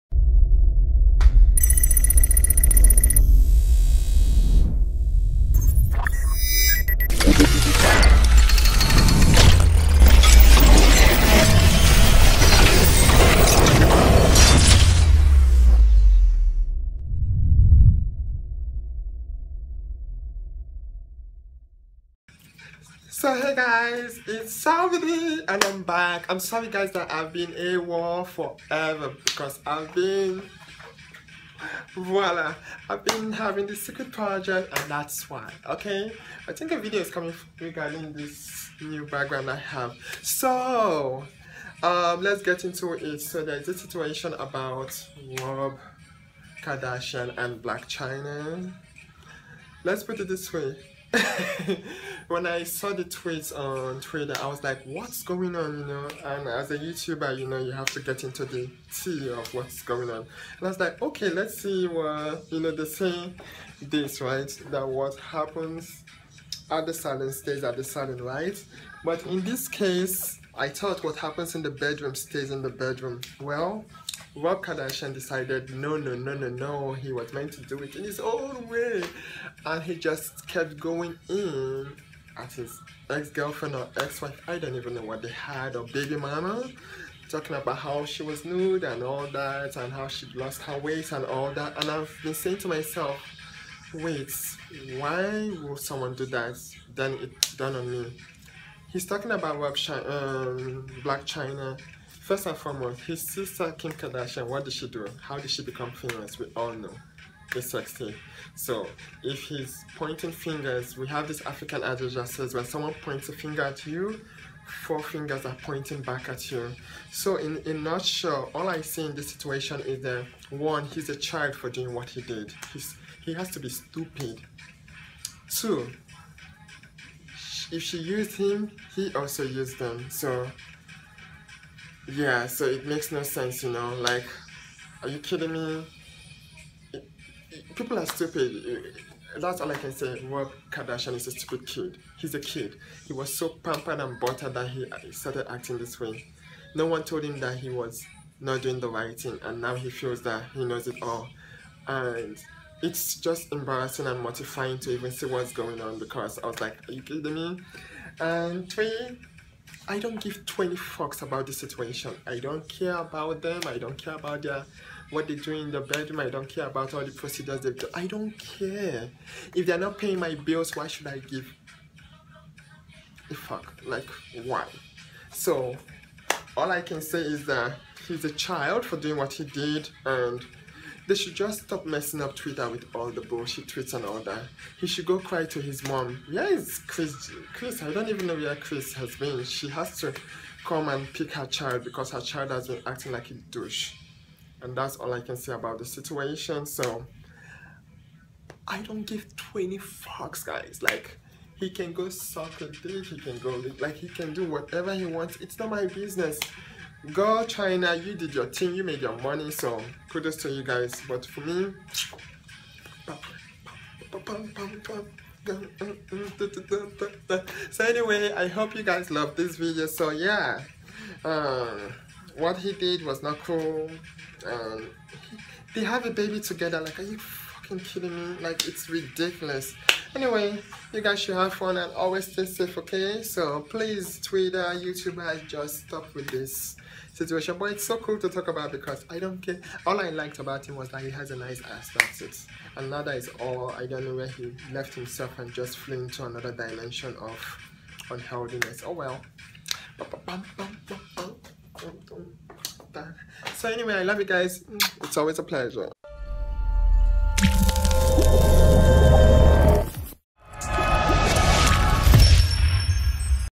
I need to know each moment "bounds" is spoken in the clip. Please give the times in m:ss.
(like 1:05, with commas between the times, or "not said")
not said.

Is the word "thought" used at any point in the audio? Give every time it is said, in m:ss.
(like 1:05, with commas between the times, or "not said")
1:10.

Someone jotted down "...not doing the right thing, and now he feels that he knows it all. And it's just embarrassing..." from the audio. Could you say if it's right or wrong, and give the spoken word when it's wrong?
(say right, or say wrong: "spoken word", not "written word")
right.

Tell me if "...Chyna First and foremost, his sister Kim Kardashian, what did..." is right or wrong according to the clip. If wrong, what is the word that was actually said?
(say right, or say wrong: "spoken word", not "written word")
right.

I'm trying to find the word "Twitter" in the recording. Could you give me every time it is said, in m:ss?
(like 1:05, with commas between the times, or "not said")
0:53, 3:02, 3:54.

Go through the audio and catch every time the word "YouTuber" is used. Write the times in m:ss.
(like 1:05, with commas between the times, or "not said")
0:56, 3:54.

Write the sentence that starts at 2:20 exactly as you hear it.
Rob Kardashian is a stupid kid.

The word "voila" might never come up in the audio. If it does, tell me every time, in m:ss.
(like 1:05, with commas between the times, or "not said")
0:31.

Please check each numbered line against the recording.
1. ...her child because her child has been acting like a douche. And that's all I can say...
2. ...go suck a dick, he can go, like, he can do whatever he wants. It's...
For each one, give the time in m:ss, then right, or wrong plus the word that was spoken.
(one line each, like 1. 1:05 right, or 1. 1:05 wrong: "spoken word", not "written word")
1. 3:11 right
2. 3:21 right.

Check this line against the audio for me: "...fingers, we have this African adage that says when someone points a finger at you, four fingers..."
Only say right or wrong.
right.